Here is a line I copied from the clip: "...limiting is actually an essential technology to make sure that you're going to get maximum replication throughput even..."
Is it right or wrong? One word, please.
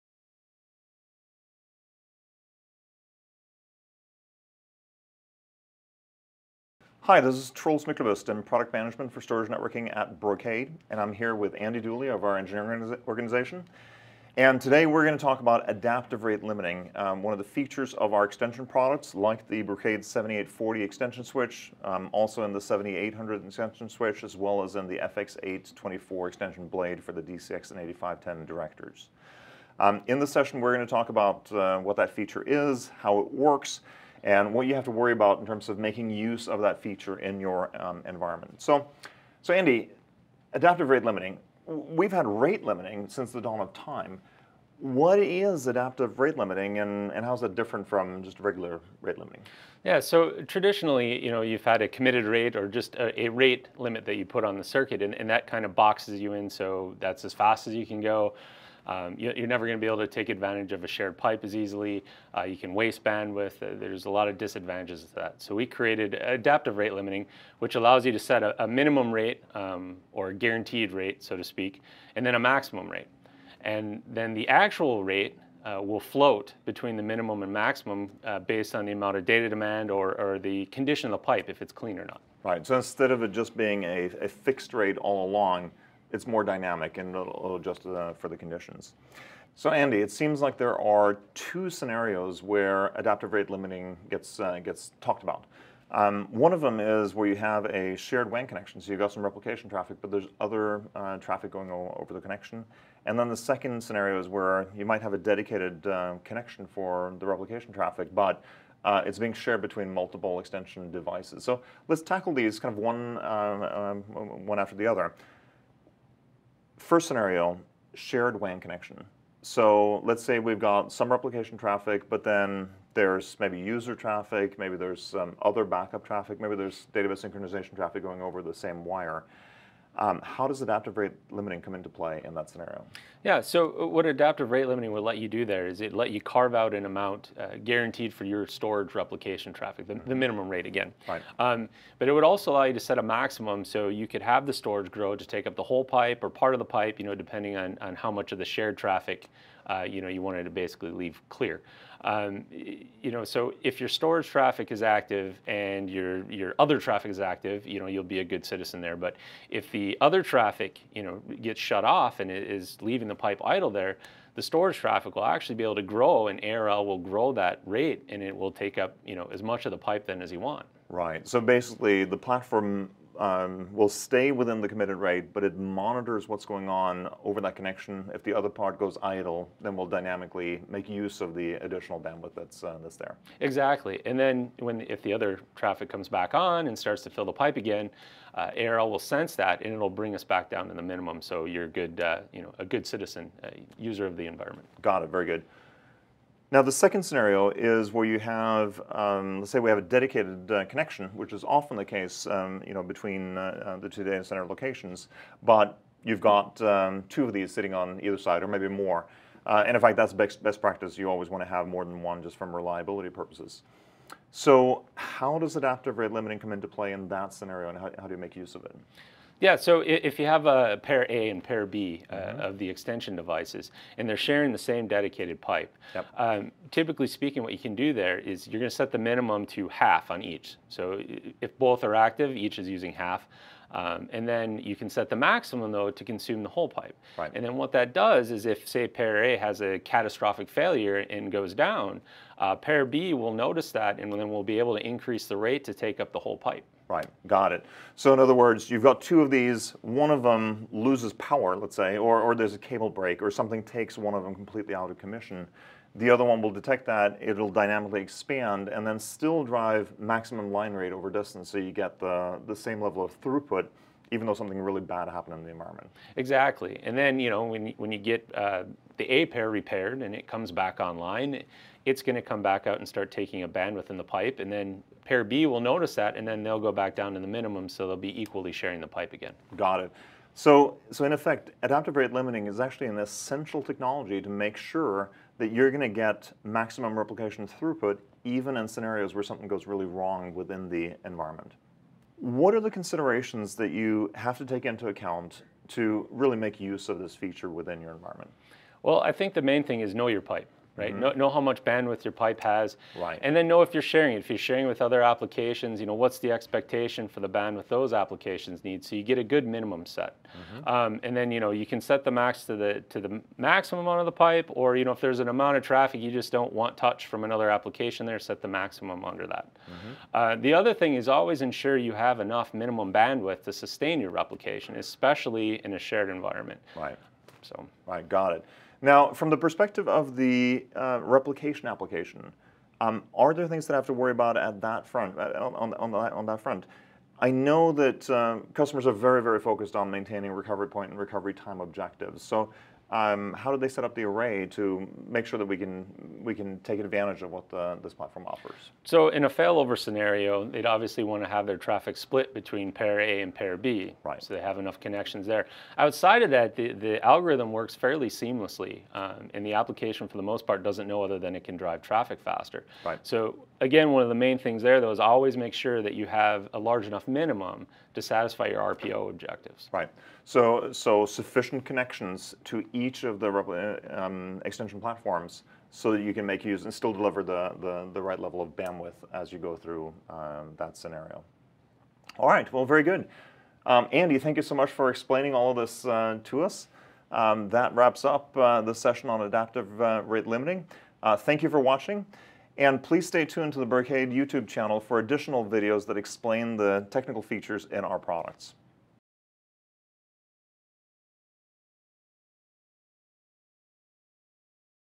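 right.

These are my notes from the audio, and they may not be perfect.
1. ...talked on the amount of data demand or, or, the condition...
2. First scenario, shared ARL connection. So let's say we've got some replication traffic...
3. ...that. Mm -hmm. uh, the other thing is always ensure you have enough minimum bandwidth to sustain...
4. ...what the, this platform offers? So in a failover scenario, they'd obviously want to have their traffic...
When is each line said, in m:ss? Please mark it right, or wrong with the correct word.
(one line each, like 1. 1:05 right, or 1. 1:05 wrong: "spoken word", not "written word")
1. 1:18 wrong: "based", not "talked"
2. 1:56 wrong: "WAN", not "ARL"
3. 5:19 right
4. 5:47 right.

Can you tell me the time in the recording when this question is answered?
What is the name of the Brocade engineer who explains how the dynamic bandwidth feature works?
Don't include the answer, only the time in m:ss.
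0:11.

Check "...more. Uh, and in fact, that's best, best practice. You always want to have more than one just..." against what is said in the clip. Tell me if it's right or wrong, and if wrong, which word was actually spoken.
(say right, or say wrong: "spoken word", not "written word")
right.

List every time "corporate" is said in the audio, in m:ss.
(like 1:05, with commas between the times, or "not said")
not said.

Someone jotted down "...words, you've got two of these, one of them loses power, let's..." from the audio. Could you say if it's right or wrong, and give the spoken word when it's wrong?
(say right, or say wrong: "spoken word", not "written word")
right.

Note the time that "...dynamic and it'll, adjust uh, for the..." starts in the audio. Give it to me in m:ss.
1:26.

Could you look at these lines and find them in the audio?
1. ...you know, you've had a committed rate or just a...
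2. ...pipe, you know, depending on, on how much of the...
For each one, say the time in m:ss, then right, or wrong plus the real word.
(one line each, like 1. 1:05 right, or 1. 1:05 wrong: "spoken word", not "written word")
1. 0:51 right
2. 2:26 right.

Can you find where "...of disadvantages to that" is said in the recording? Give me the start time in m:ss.
1:04.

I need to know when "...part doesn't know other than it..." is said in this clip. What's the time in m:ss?
6:00.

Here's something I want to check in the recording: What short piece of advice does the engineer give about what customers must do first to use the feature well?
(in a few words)
know your pipe.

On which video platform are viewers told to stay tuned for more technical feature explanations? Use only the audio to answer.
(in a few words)
YouTube.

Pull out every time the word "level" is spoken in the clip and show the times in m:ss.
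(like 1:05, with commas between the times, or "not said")
4:22, 6:18.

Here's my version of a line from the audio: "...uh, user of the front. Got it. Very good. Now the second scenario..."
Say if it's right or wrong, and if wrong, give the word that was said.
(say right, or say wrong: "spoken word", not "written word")
wrong: "environment", not "front".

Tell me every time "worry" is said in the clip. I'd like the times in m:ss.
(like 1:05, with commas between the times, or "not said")
0:34, 5:33.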